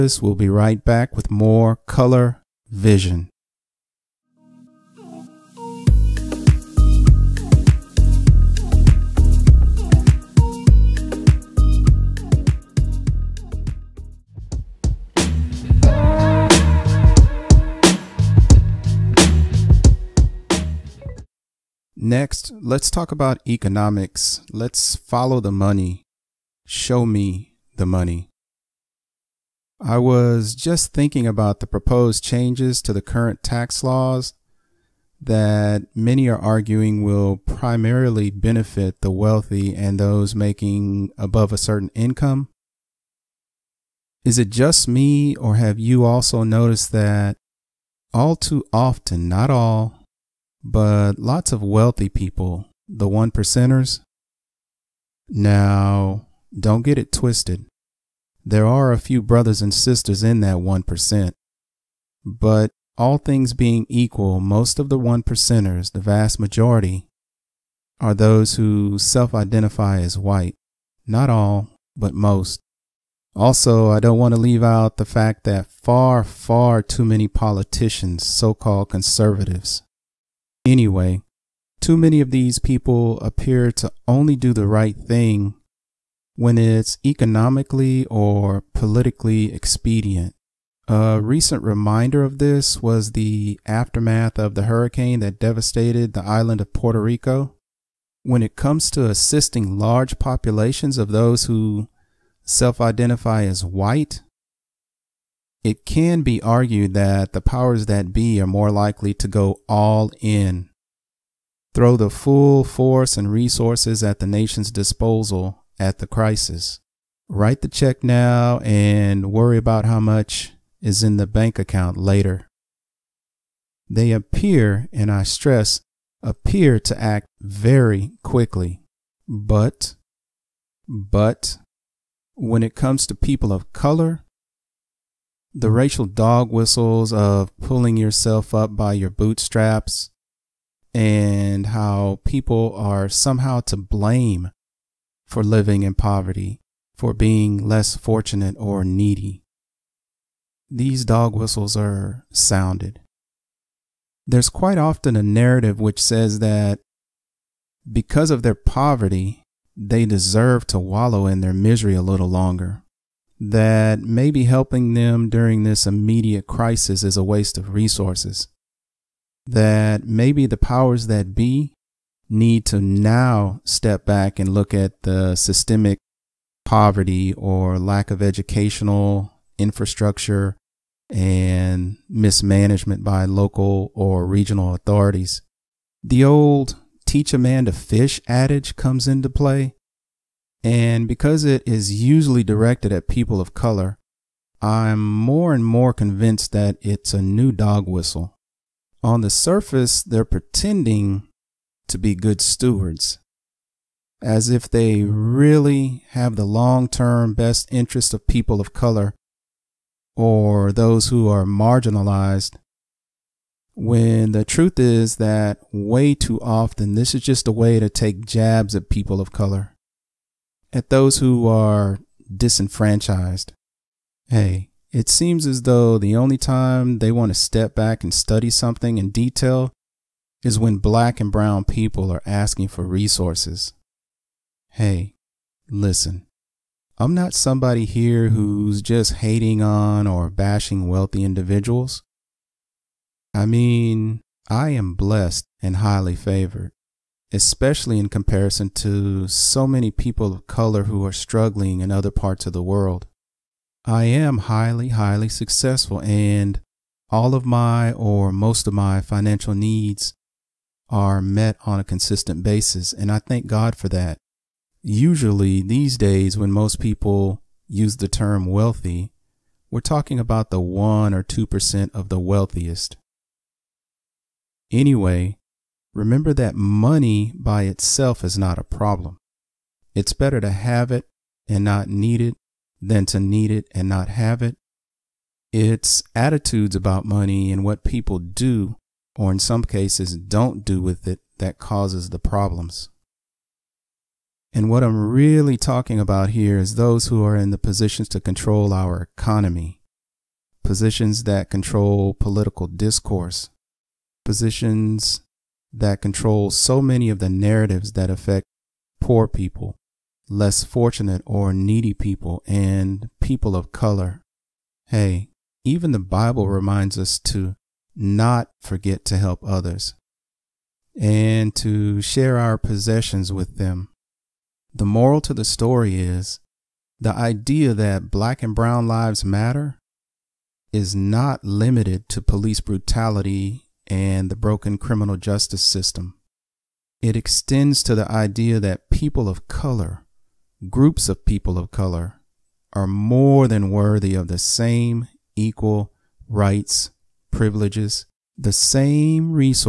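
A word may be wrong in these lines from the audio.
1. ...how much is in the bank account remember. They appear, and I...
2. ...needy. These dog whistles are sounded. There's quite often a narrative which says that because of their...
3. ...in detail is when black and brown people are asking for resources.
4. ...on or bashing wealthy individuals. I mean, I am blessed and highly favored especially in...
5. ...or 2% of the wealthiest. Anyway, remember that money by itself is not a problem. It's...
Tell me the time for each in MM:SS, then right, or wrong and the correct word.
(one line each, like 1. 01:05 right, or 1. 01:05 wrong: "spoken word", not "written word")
1. 01:59 wrong: "later", not "remember"
2. 02:28 right
3. 03:48 right
4. 03:59 right
5. 04:31 right.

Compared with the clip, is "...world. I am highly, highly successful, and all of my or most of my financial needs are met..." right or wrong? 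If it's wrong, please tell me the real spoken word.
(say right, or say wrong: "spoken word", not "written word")
right.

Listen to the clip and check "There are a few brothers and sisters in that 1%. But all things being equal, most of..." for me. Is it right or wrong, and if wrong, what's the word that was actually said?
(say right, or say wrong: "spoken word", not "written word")
right.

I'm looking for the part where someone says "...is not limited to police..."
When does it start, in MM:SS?
05:30.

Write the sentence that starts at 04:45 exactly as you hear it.
It's attitudes about money and what people do, or in some cases don't do with it, that causes the problems.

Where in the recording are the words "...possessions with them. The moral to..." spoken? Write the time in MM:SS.
05:22.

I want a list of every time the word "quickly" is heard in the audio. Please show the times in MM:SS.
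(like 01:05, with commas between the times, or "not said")
02:08.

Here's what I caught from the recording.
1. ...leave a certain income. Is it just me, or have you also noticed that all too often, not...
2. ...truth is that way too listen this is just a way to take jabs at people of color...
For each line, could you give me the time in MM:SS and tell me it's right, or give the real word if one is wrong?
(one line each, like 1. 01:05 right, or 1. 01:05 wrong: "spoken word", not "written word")
1. 00:41 wrong: "above", not "leave"
2. 03:34 wrong: "often", not "listen".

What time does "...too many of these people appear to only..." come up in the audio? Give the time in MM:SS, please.
01:21.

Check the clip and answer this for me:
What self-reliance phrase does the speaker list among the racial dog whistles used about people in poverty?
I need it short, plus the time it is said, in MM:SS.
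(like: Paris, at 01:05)
pulling yourself up by your bootstraps, at 02:17.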